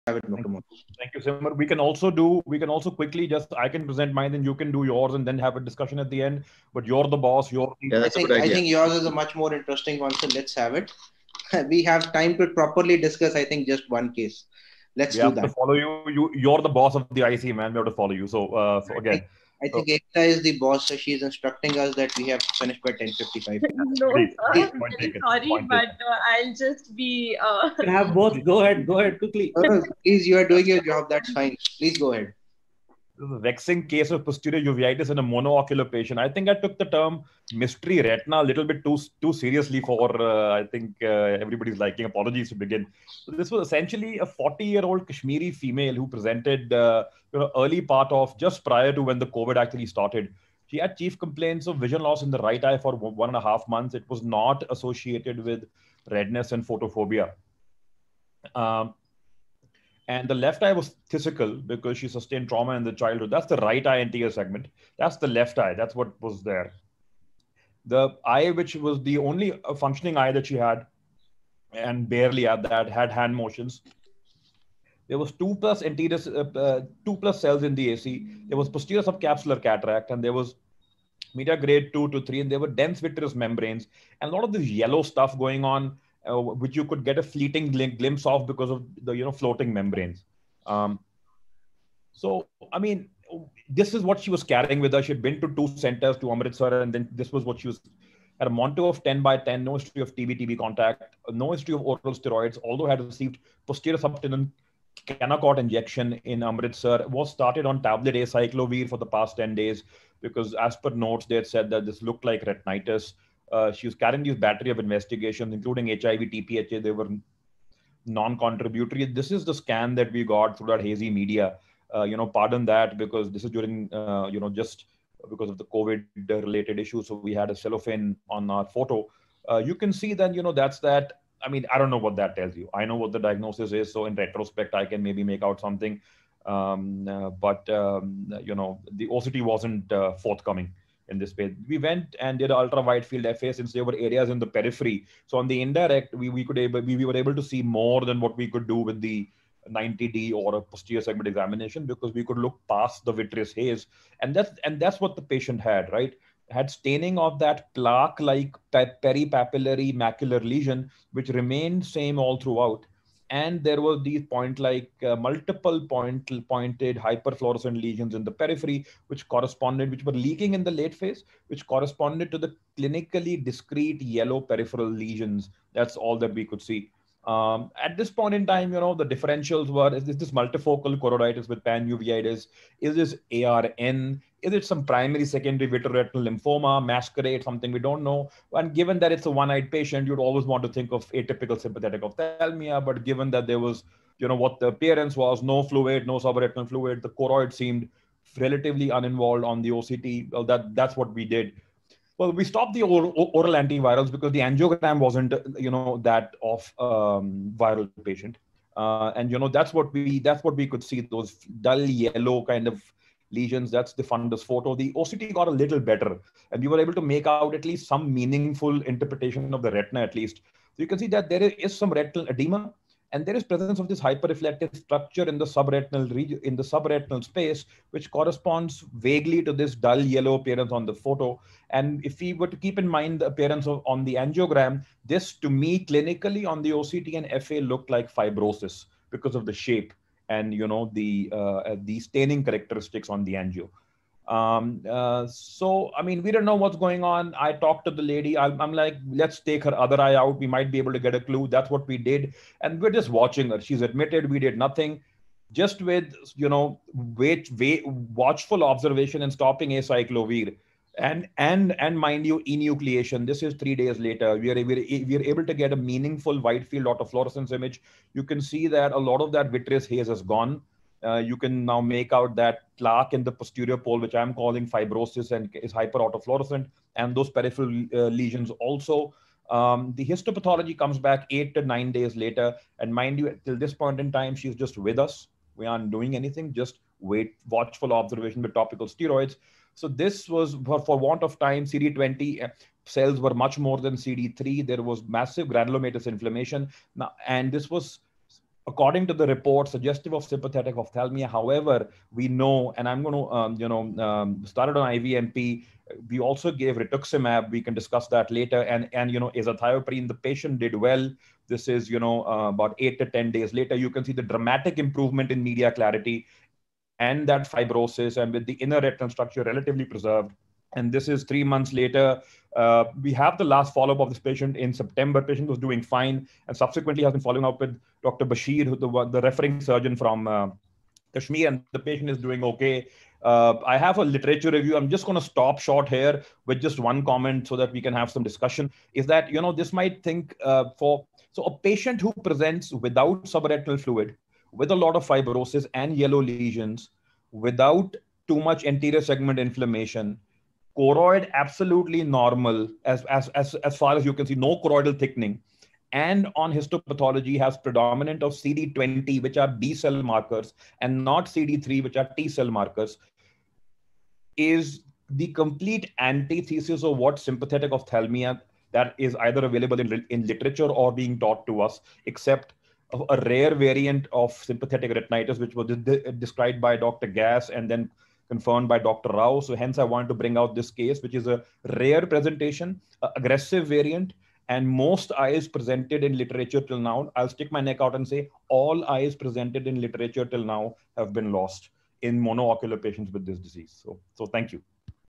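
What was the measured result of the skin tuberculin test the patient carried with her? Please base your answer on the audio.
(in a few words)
10 by 10.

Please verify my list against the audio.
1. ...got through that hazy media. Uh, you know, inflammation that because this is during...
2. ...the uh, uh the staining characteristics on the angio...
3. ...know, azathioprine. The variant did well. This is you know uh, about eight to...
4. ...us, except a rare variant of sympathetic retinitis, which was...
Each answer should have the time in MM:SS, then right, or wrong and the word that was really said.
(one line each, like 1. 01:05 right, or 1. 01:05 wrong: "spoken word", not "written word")
1. 02:00 wrong: "pardon", not "inflammation"
2. 04:00 right
3. 05:09 wrong: "patient", not "variant"
4. 06:11 right.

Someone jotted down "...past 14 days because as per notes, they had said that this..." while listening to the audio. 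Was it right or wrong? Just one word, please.
wrong.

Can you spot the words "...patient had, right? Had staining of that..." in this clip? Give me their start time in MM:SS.
02:35.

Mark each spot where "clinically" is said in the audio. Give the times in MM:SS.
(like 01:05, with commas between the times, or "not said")
02:52, 03:55.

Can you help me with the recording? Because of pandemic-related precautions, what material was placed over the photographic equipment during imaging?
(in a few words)
cellophane.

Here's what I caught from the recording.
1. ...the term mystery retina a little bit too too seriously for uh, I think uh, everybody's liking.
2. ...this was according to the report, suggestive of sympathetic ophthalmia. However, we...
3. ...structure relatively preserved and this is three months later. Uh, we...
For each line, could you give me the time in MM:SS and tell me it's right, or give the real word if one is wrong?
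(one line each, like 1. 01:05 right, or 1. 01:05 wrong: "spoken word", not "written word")
1. 00:36 right
2. 04:57 right
3. 05:19 right.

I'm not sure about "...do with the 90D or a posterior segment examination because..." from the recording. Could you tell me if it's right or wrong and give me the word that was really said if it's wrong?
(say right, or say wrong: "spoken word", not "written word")
right.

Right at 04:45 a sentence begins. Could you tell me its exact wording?
We aren't doing anything, just wait, watchful observation with topical steroids.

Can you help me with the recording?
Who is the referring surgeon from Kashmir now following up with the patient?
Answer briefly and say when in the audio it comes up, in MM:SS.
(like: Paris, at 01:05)
Dr. Bashir, at 05:28.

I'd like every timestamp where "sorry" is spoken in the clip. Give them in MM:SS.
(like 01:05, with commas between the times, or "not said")
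00:25.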